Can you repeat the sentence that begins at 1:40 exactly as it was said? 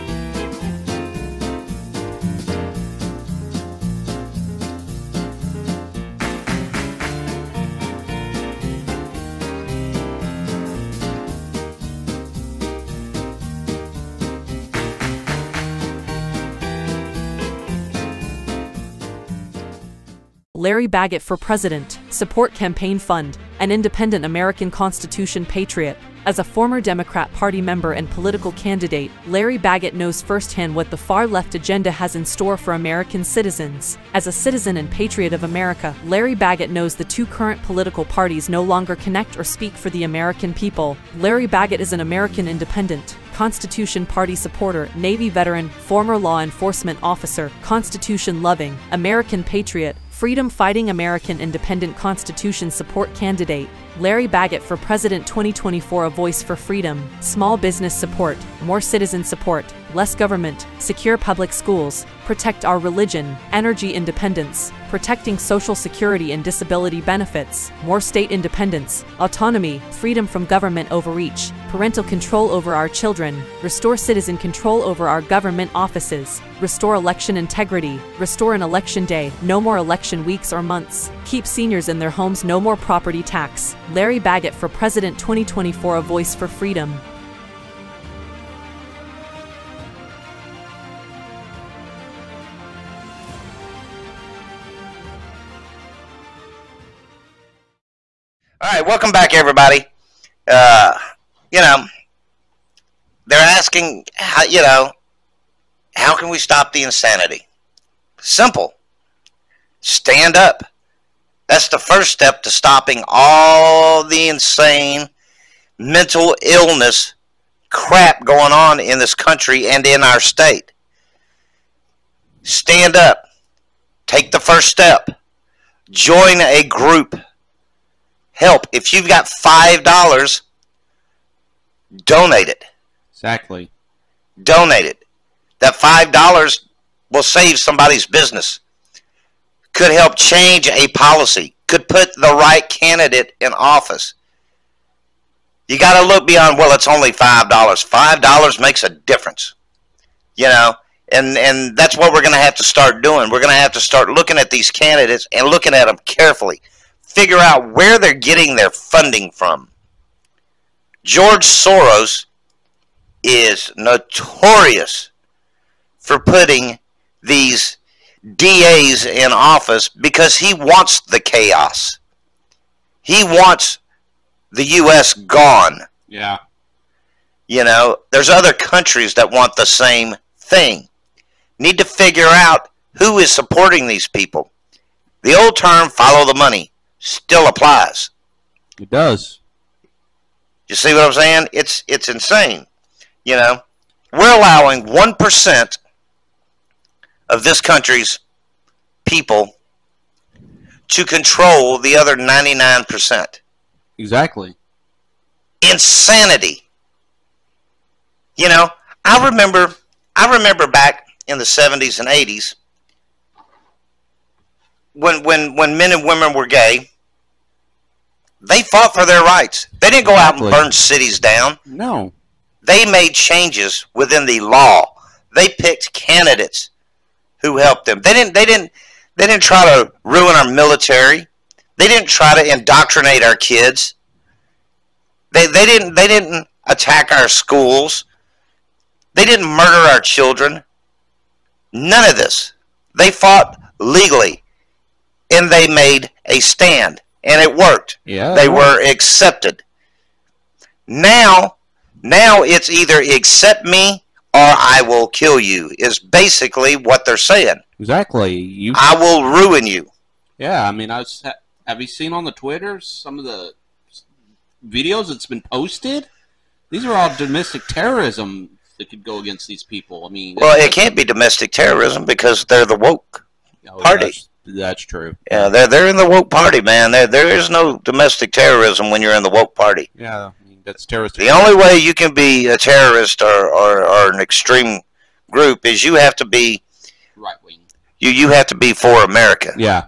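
Uh, you know, they're asking, how, you know, how can we stop the insanity?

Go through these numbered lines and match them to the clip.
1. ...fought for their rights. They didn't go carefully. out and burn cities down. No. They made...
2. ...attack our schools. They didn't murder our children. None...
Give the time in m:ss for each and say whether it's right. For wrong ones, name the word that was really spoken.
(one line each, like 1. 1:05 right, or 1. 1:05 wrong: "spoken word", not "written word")
1. 3:38 wrong: "exactly", not "carefully"
2. 3:56 right.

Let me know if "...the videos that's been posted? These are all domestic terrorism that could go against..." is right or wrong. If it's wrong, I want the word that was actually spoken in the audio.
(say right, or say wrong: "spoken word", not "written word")
right.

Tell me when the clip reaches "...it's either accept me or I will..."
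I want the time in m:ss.
4:12.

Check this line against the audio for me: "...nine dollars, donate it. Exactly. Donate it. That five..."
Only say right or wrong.
wrong.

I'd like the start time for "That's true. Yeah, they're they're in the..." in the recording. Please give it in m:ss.
4:34.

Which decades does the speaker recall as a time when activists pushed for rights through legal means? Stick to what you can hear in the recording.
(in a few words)
70s and 80s.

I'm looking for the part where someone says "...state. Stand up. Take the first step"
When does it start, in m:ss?
2:00.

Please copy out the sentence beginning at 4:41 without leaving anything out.
The only way you can be a terrorist or, or, or an extreme group is you have to be right wing.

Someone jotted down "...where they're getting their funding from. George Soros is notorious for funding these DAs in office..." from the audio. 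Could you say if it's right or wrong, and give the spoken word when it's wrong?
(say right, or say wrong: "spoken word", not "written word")
wrong: "putting", not "funding".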